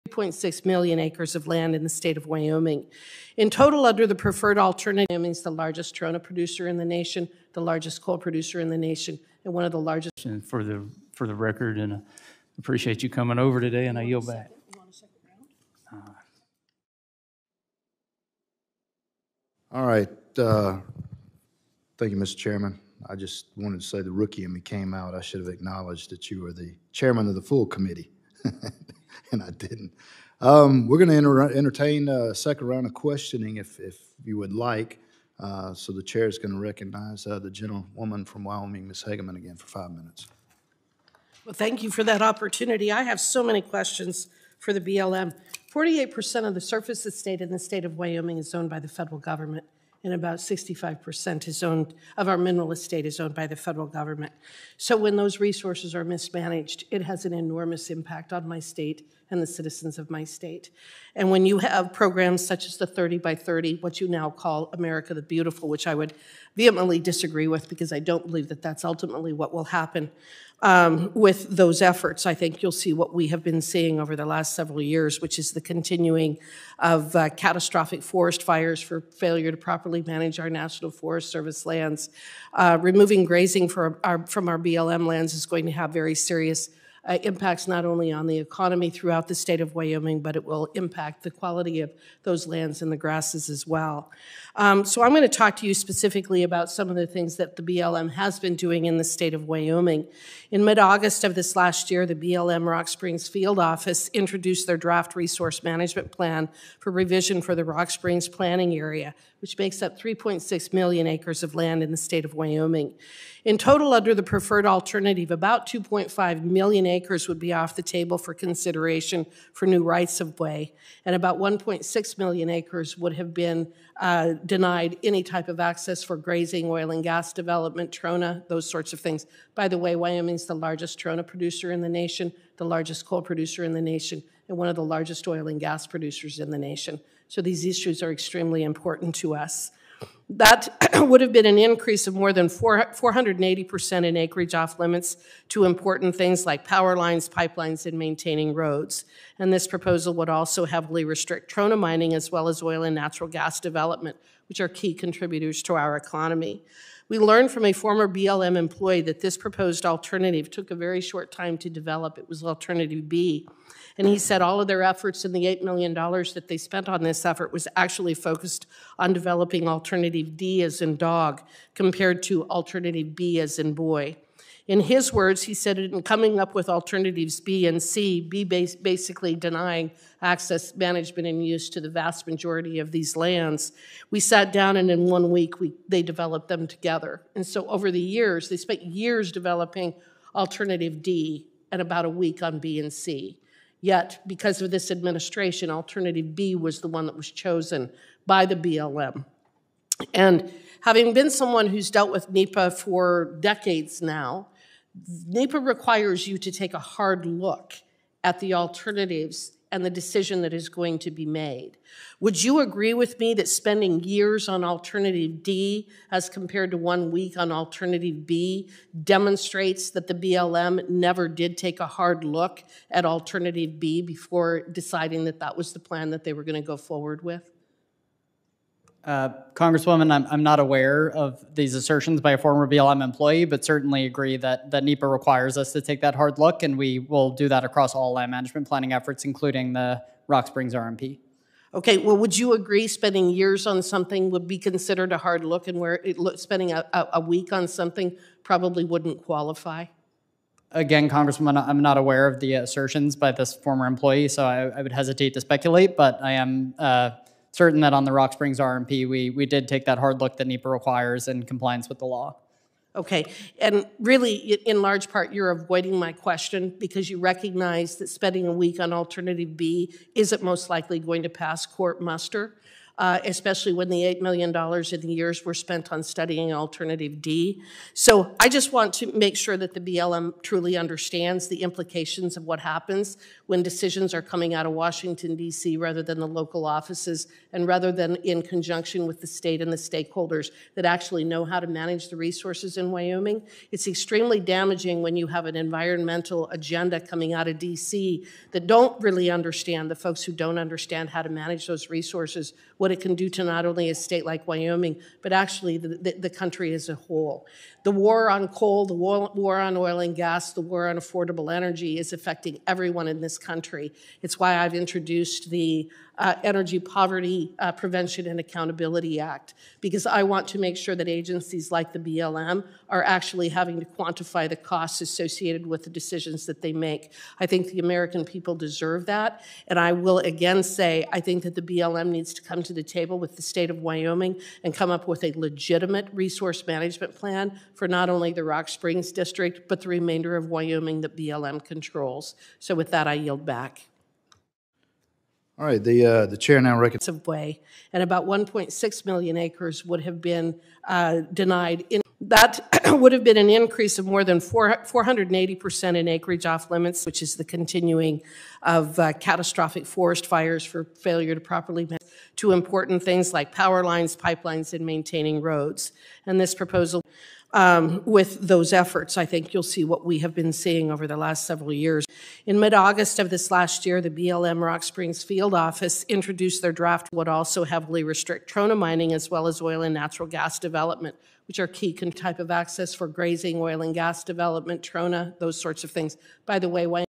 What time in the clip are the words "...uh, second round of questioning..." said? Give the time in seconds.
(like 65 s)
32 s.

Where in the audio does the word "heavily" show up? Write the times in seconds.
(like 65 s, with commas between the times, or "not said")
150 s, 377 s.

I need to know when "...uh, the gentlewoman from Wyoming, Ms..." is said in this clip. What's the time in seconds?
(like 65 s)
37 s.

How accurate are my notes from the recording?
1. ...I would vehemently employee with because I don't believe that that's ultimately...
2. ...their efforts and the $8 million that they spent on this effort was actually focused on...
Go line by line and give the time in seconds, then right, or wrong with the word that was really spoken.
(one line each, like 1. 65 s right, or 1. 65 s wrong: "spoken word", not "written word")
1. 65 s wrong: "disagree", not "employee"
2. 164 s right.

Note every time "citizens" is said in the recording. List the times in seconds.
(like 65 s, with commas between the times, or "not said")
59 s.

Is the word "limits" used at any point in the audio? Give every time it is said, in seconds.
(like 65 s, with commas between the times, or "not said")
144 s, 356 s.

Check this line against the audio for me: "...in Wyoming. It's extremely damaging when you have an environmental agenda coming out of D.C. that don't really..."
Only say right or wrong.
right.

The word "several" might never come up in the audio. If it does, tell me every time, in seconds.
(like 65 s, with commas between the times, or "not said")
74 s, 371 s.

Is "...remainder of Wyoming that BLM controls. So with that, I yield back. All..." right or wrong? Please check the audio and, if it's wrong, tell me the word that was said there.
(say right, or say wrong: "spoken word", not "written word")
right.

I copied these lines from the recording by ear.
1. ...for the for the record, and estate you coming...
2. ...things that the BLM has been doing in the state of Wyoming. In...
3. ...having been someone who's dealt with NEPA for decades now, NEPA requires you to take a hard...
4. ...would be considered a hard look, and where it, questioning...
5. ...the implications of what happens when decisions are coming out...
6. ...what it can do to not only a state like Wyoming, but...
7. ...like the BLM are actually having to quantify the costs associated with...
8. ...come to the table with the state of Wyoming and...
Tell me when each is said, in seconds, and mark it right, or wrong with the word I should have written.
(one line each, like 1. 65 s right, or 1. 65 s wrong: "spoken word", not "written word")
1. 10 s wrong: "appreciate", not "estate"
2. 97 s right
3. 200 s right
4. 244 s wrong: "spending", not "questioning"
5. 281 s right
6. 302 s right
7. 321 s right
8. 332 s right.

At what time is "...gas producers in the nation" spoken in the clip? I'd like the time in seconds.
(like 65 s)
135 s.